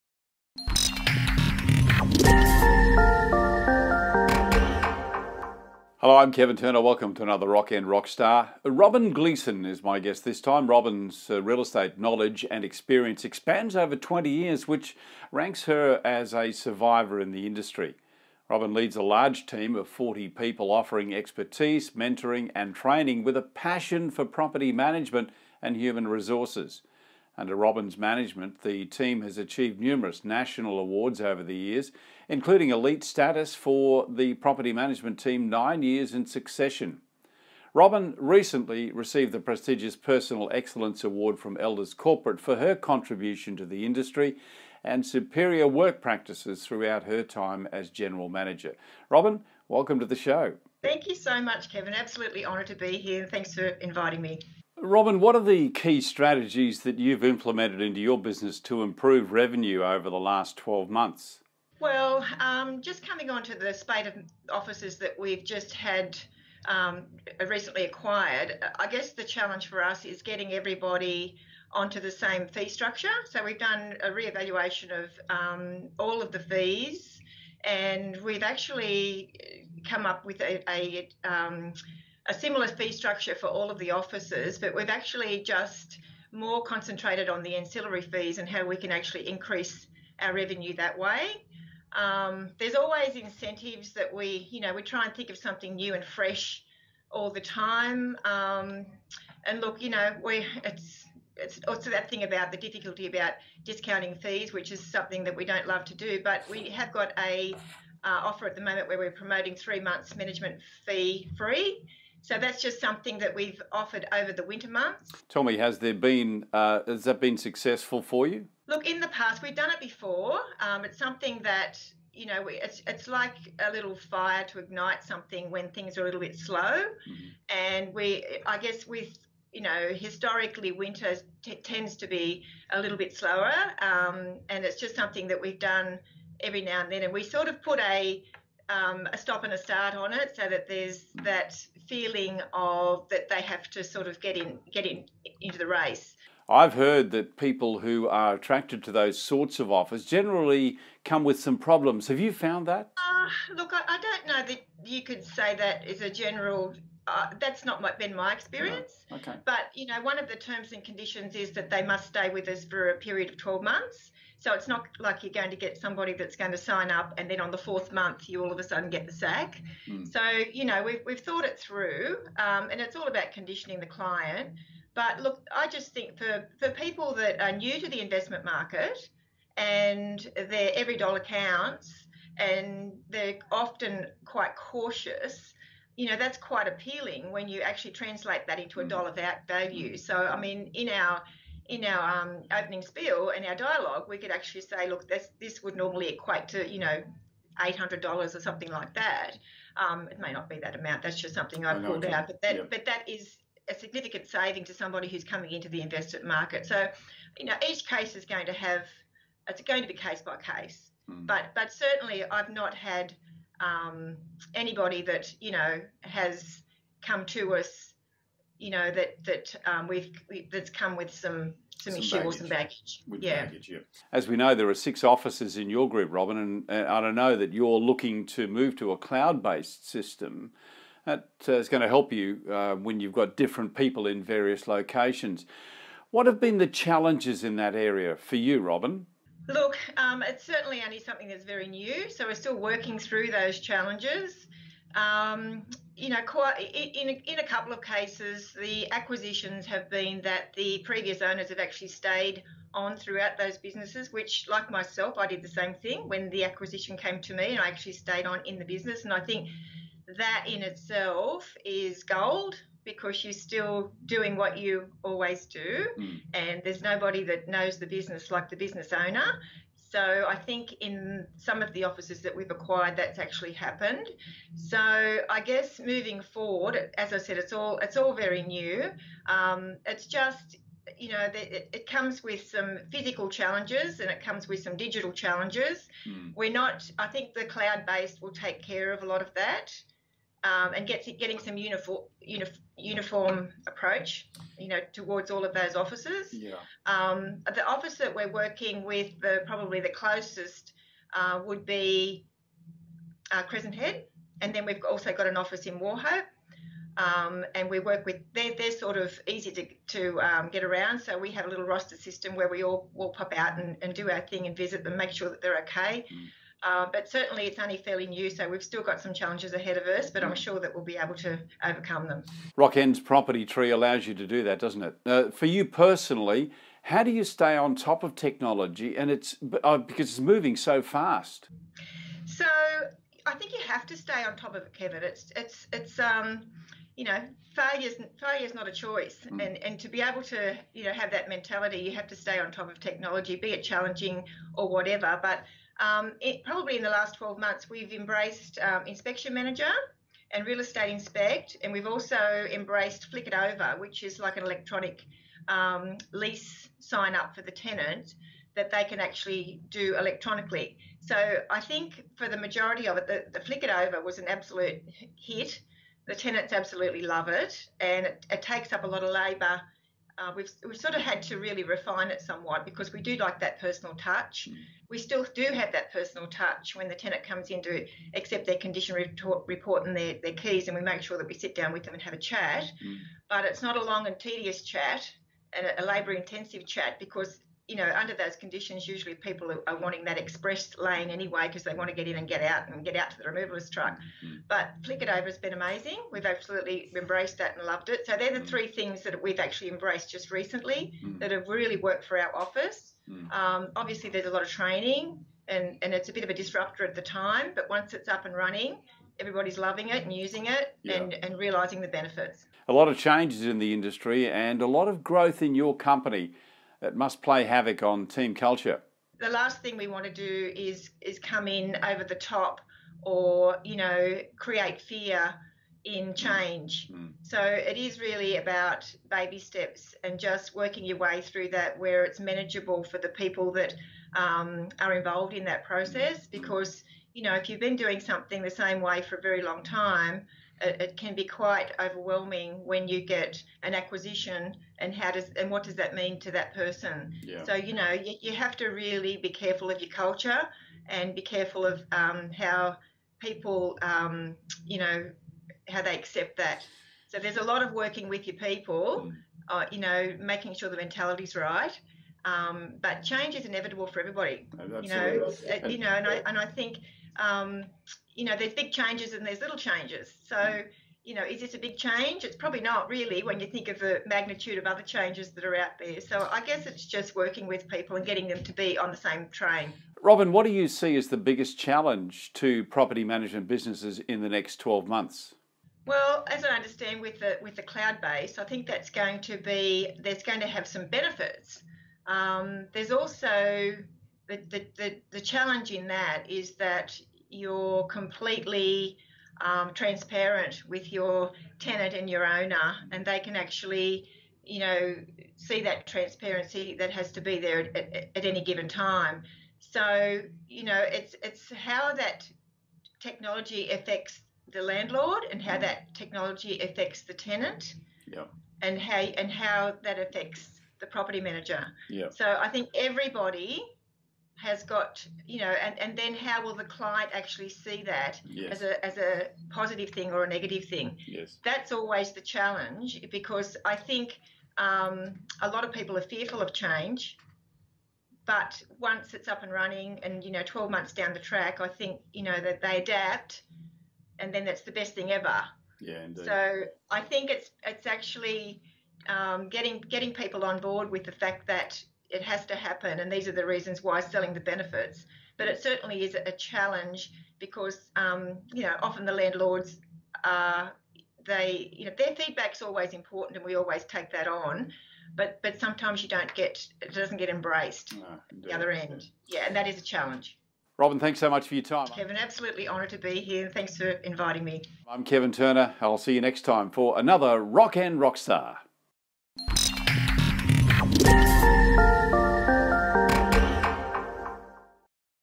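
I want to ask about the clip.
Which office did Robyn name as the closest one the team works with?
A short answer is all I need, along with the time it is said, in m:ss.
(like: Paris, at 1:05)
Crescent Head, at 5:03.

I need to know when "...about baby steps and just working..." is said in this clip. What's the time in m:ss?
7:08.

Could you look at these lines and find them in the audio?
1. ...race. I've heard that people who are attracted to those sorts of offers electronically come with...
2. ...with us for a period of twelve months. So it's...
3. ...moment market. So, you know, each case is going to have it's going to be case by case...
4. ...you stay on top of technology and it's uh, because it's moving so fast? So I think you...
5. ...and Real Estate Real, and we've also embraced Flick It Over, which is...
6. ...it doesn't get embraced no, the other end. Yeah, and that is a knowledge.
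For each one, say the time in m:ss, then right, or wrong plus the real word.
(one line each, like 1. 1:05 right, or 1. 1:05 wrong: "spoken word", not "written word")
1. 2:25 wrong: "generally", not "electronically"
2. 2:42 right
3. 3:25 wrong: "investment", not "moment"
4. 5:27 right
5. 5:50 wrong: "Inspect", not "Real"
6. 9:26 wrong: "challenge", not "knowledge".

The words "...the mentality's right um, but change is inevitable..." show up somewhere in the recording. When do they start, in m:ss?
7:40.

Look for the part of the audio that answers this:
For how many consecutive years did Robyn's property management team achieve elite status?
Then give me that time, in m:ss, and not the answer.
0:35.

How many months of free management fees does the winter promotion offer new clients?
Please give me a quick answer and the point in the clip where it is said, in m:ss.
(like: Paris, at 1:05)
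3, at 1:49.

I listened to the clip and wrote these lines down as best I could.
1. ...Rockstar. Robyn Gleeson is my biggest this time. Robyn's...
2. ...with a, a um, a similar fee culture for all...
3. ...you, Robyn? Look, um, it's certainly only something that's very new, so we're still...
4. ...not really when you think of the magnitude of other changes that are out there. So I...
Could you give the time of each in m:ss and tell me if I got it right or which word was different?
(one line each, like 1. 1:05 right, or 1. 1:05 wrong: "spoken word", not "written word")
1. 0:07 wrong: "guest", not "biggest"
2. 1:20 wrong: "structure", not "culture"
3. 3:58 right
4. 7:52 right.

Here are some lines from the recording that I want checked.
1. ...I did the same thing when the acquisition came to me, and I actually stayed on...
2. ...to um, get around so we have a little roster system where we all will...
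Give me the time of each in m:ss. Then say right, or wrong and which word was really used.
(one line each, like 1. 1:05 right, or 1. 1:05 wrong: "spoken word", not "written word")
1. 4:15 right
2. 5:09 right.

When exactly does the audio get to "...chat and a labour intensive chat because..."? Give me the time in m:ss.
6:24.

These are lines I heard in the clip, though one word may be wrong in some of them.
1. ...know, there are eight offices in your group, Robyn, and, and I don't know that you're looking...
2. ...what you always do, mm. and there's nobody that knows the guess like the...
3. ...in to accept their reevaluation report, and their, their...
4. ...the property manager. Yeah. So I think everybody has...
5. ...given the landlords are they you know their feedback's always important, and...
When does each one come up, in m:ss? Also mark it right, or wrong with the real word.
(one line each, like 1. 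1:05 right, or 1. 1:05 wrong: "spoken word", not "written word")
1. 3:44 wrong: "six", not "eight"
2. 4:24 wrong: "business", not "guess"
3. 6:17 wrong: "condition", not "reevaluation"
4. 8:40 right
5. 9:18 wrong: "often", not "given".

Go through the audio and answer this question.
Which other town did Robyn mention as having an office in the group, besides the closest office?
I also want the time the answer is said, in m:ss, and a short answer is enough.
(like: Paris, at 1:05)
Wauchope, at 5:05.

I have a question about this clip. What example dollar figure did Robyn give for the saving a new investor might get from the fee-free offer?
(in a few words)
$800.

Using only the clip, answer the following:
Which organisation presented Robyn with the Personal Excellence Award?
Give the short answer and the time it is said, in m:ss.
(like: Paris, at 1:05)
Elders Corporate, at 0:41.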